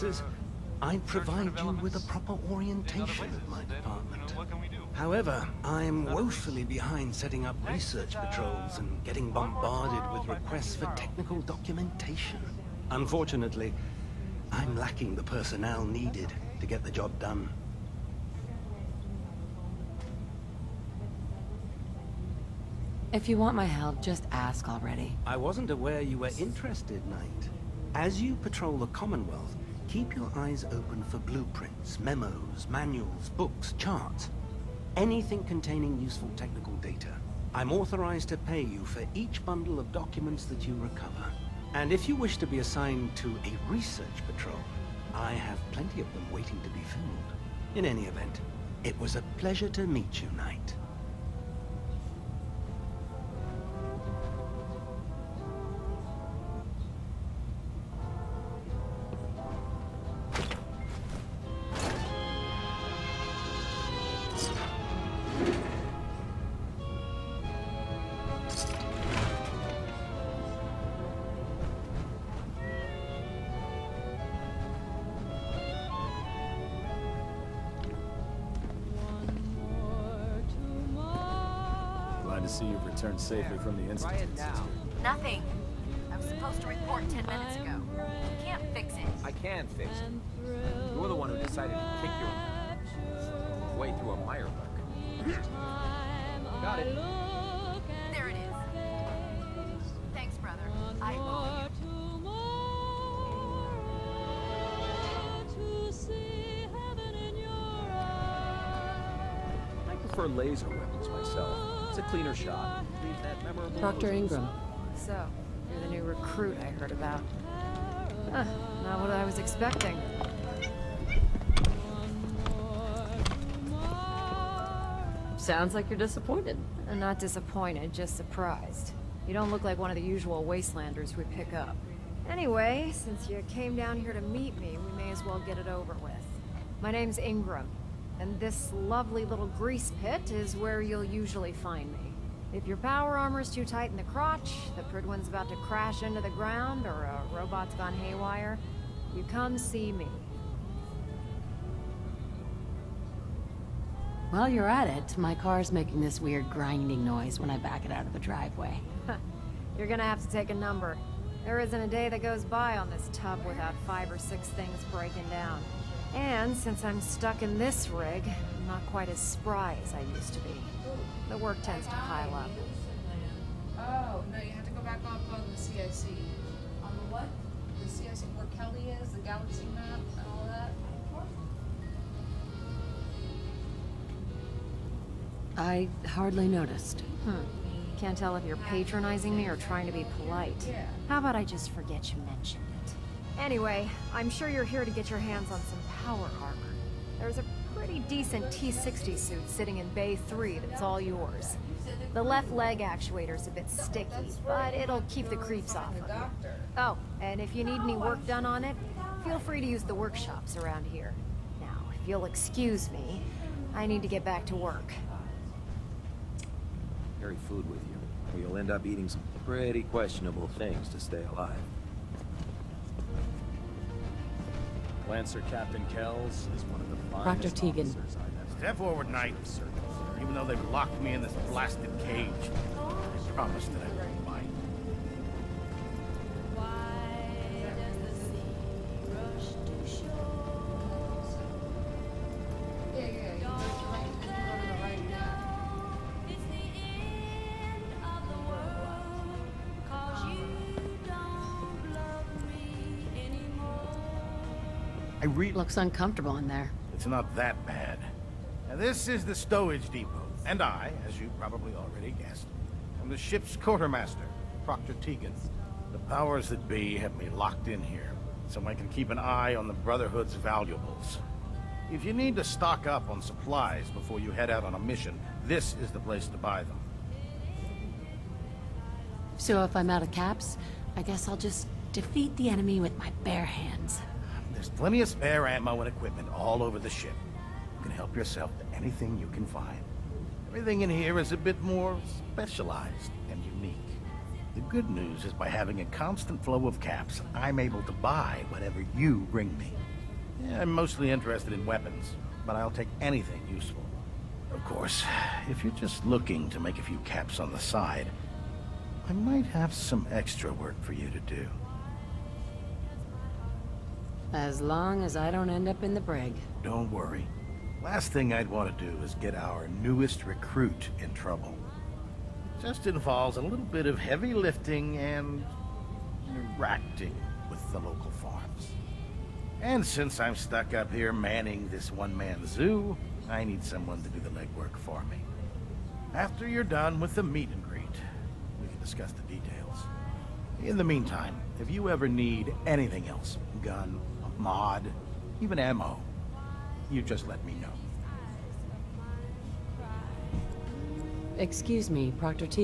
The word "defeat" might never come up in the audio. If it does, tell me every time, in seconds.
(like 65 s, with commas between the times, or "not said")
281 s.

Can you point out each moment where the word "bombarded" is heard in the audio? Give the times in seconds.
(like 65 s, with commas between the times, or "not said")
9 s.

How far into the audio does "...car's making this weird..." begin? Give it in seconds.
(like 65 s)
155 s.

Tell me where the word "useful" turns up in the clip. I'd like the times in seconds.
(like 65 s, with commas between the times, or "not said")
35 s, 303 s.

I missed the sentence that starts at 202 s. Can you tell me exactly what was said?
The left leg actuator's a bit sticky, but it'll keep the creeps off of you.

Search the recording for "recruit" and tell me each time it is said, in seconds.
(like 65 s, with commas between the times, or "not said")
116 s, 320 s.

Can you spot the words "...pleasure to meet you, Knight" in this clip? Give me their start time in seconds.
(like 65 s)
49 s.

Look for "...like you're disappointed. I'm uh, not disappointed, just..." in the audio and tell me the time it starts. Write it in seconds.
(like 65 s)
125 s.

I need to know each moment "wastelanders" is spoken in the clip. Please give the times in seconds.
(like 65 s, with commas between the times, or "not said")
130 s.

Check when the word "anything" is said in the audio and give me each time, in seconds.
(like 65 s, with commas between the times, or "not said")
34 s, 288 s, 302 s, 342 s.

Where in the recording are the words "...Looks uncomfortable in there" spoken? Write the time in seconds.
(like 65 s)
255 s.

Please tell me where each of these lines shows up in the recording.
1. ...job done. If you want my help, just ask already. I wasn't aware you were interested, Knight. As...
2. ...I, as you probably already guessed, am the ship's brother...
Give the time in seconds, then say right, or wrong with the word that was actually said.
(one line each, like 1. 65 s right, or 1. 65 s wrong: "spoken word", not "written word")
1. 16 s right
2. 260 s wrong: "quartermaster", not "brother".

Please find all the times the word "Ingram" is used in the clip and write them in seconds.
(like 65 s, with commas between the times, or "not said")
114 s, 137 s.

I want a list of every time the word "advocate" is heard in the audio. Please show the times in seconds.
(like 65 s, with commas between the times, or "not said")
not said.